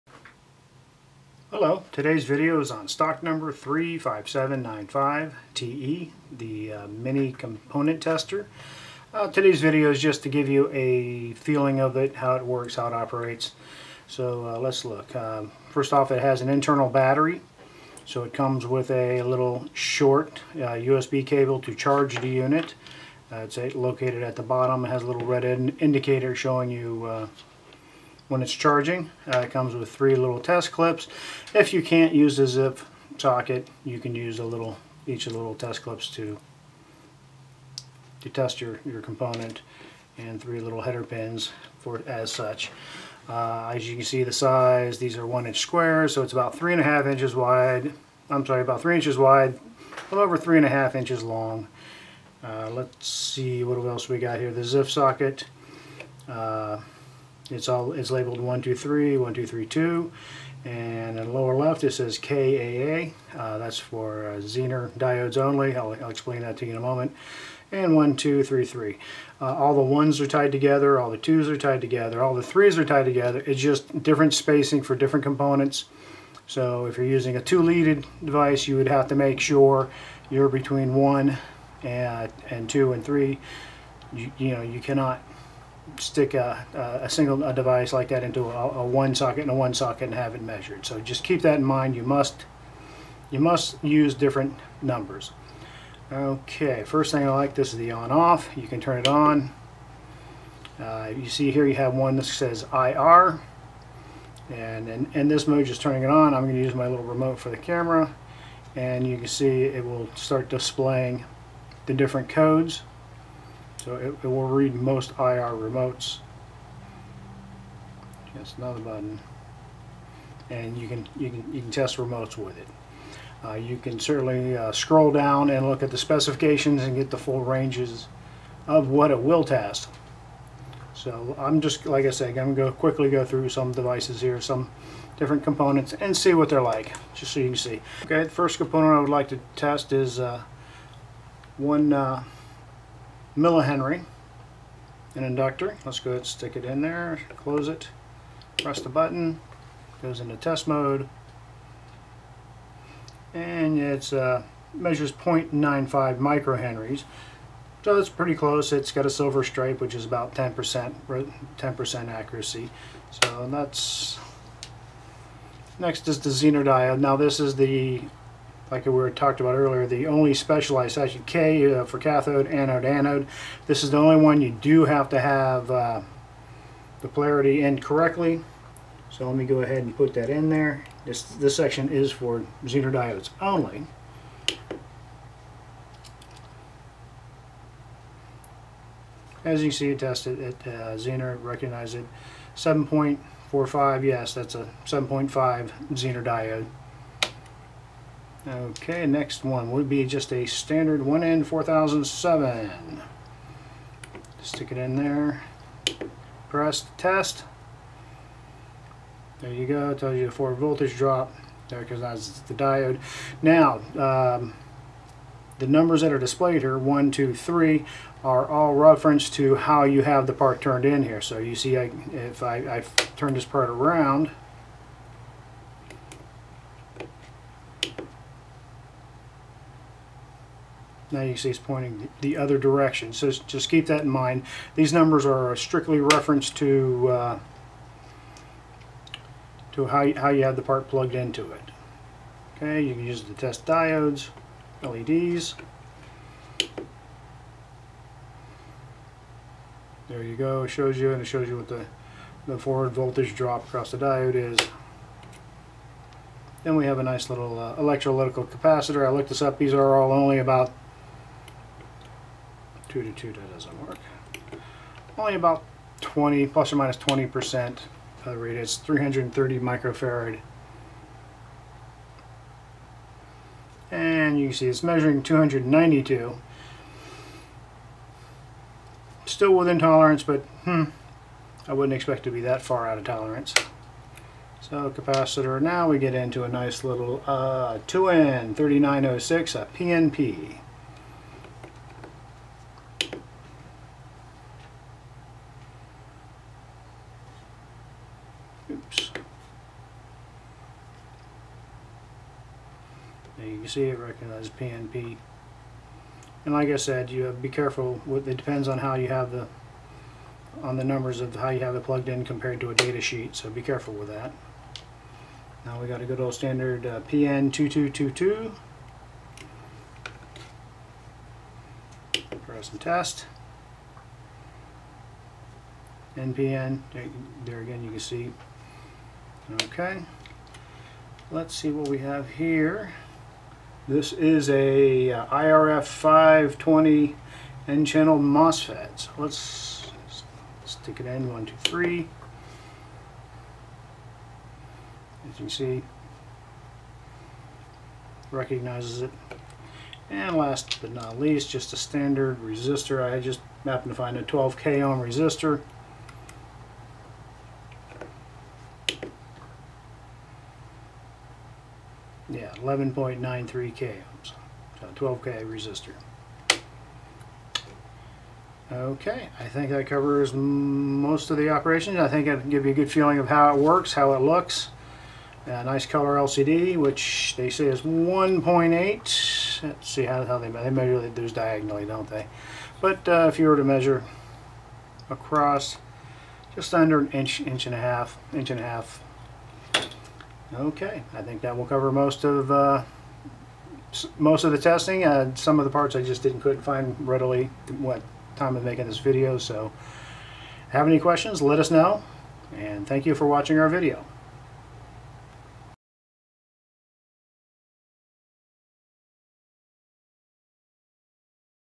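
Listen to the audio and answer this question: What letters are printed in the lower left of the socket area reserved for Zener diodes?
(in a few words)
KAA.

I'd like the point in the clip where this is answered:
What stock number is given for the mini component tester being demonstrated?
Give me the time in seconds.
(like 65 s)
3 s.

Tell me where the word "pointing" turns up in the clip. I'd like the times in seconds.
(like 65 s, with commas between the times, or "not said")
231 s.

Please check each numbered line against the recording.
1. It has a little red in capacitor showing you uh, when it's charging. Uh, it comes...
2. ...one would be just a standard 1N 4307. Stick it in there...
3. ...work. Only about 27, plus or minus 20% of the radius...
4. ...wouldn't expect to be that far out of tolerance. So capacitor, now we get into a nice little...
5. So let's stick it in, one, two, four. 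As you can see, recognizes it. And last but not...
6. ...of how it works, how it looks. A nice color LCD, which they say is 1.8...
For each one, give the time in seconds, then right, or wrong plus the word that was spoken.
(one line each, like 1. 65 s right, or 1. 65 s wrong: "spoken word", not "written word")
1. 24 s wrong: "indicator", not "capacitor"
2. 199 s wrong: "4007", not "4307"
3. 263 s wrong: "20", not "27"
4. 281 s right
5. 338 s wrong: "three", not "four"
6. 373 s right.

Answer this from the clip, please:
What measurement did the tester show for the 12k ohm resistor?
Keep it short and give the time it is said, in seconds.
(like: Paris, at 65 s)
11.93K ohms, at 362 s.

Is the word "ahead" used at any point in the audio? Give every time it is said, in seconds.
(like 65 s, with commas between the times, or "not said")
146 s, 179 s.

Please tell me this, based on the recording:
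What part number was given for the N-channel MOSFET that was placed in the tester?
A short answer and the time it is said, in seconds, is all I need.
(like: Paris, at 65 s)
IRF 520, at 335 s.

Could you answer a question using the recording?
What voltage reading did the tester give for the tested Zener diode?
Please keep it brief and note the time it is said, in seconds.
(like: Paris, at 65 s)
7.45, at 192 s.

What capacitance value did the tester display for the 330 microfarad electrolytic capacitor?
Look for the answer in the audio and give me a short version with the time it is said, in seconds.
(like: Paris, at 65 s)
292, at 275 s.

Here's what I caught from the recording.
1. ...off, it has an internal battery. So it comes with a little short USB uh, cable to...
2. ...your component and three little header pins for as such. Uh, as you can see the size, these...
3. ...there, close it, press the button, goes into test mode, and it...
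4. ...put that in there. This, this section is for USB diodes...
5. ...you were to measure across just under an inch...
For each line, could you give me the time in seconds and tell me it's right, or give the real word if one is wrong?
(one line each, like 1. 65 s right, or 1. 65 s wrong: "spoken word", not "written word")
1. 15 s right
2. 38 s right
3. 146 s right
4. 179 s wrong: "Zener", not "USB"
5. 383 s right.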